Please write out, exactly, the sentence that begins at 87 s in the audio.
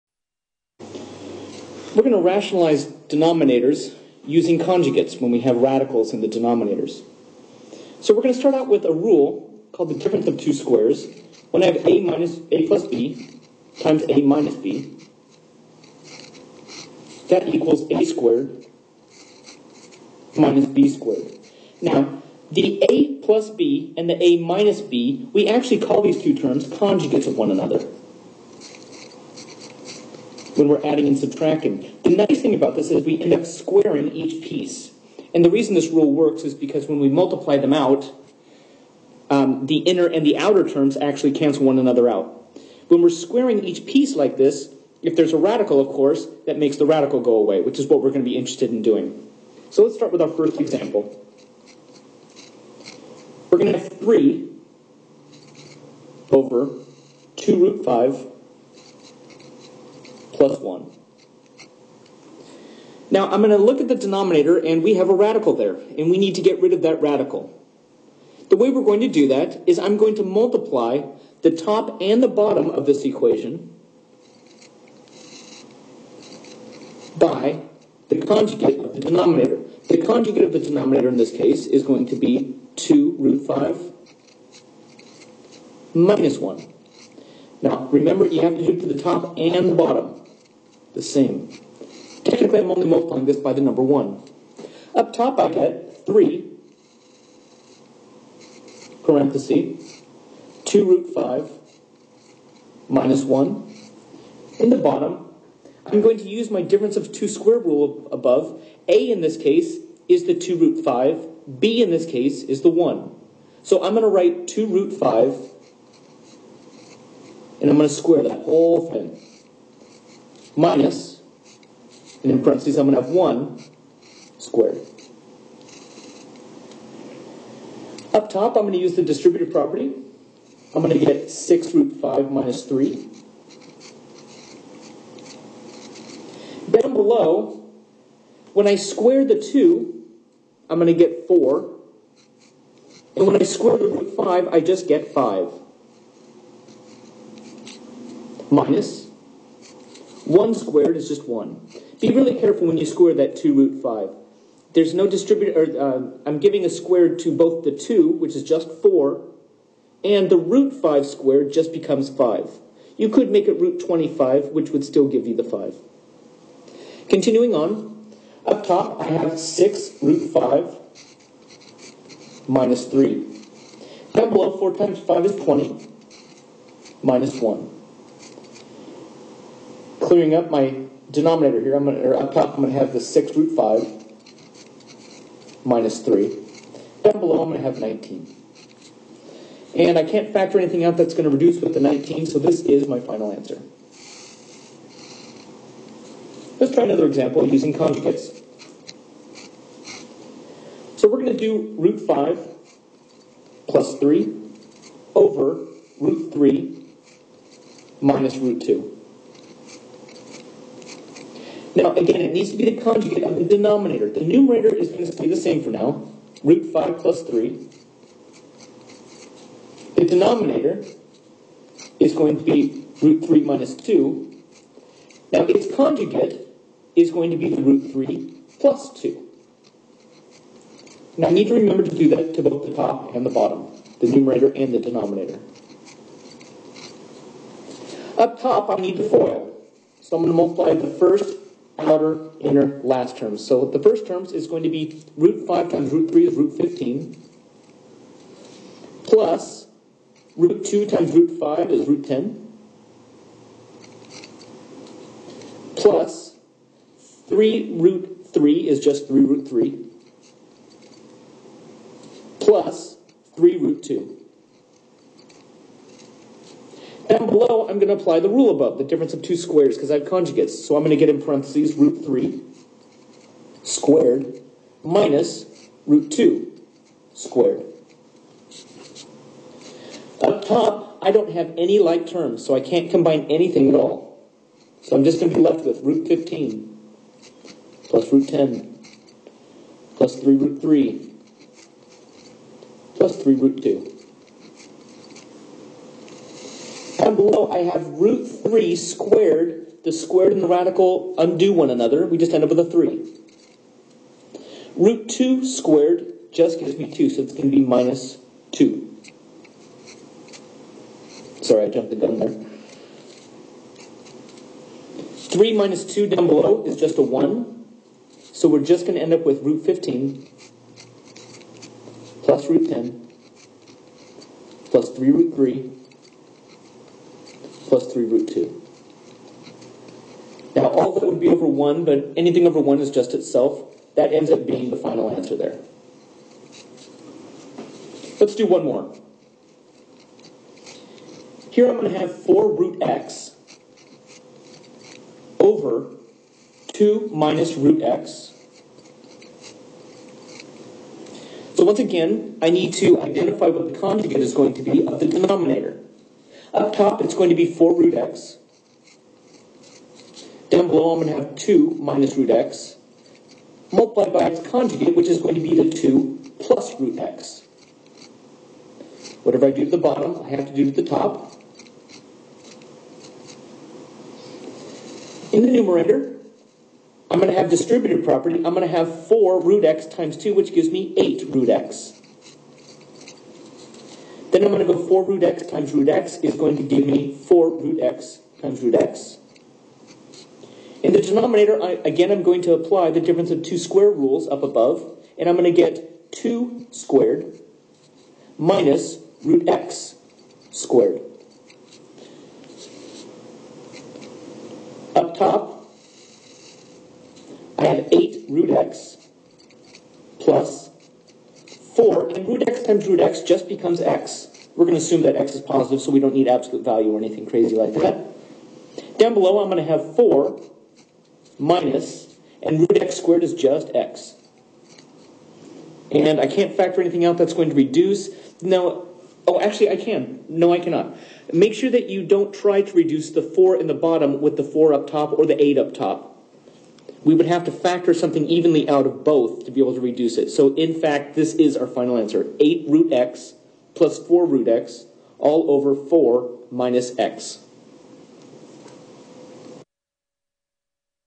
Now remember you have to do it to the top and the bottom the same.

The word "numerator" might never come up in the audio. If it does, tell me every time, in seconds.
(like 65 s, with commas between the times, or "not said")
214 s, 234 s, 375 s.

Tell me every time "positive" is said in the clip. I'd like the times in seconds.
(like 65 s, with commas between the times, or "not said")
415 s.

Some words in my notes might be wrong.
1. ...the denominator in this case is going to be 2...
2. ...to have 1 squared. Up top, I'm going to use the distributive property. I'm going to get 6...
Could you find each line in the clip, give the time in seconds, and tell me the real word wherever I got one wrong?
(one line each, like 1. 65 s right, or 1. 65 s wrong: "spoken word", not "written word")
1. 80 s right
2. 123 s right.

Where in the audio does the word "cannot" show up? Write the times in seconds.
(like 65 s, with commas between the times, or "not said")
430 s.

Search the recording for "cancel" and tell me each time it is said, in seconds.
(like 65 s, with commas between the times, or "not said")
41 s.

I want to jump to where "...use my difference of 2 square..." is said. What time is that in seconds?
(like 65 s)
106 s.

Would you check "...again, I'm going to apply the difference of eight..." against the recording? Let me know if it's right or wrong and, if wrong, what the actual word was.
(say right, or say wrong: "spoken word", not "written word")
wrong: "two", not "eight".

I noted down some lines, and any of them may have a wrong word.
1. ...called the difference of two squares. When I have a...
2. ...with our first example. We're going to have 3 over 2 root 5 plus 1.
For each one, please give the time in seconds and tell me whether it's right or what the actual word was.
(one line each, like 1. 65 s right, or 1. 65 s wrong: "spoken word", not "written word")
1. 9 s right
2. 50 s right.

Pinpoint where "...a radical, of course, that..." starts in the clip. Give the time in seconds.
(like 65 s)
45 s.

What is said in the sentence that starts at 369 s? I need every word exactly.
Whatever I do to the bottom, I have to do to the top.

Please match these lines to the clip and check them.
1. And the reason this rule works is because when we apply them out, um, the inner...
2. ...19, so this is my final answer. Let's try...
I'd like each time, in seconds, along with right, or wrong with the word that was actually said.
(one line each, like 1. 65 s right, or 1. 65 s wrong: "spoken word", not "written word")
1. 35 s wrong: "multiply", not "apply"
2. 191 s right.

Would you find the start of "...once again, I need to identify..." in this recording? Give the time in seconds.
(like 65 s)
351 s.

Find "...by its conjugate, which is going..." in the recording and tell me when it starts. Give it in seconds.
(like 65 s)
364 s.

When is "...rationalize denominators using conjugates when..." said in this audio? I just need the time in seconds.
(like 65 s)
2 s.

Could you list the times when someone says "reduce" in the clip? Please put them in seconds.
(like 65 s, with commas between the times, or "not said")
191 s, 427 s, 432 s, 439 s.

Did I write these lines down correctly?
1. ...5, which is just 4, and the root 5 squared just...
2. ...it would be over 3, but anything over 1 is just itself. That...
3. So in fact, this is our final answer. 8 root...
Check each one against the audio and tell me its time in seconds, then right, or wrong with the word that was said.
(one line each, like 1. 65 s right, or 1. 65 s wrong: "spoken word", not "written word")
1. 157 s wrong: "2", not "5"
2. 331 s wrong: "1", not "3"
3. 440 s right.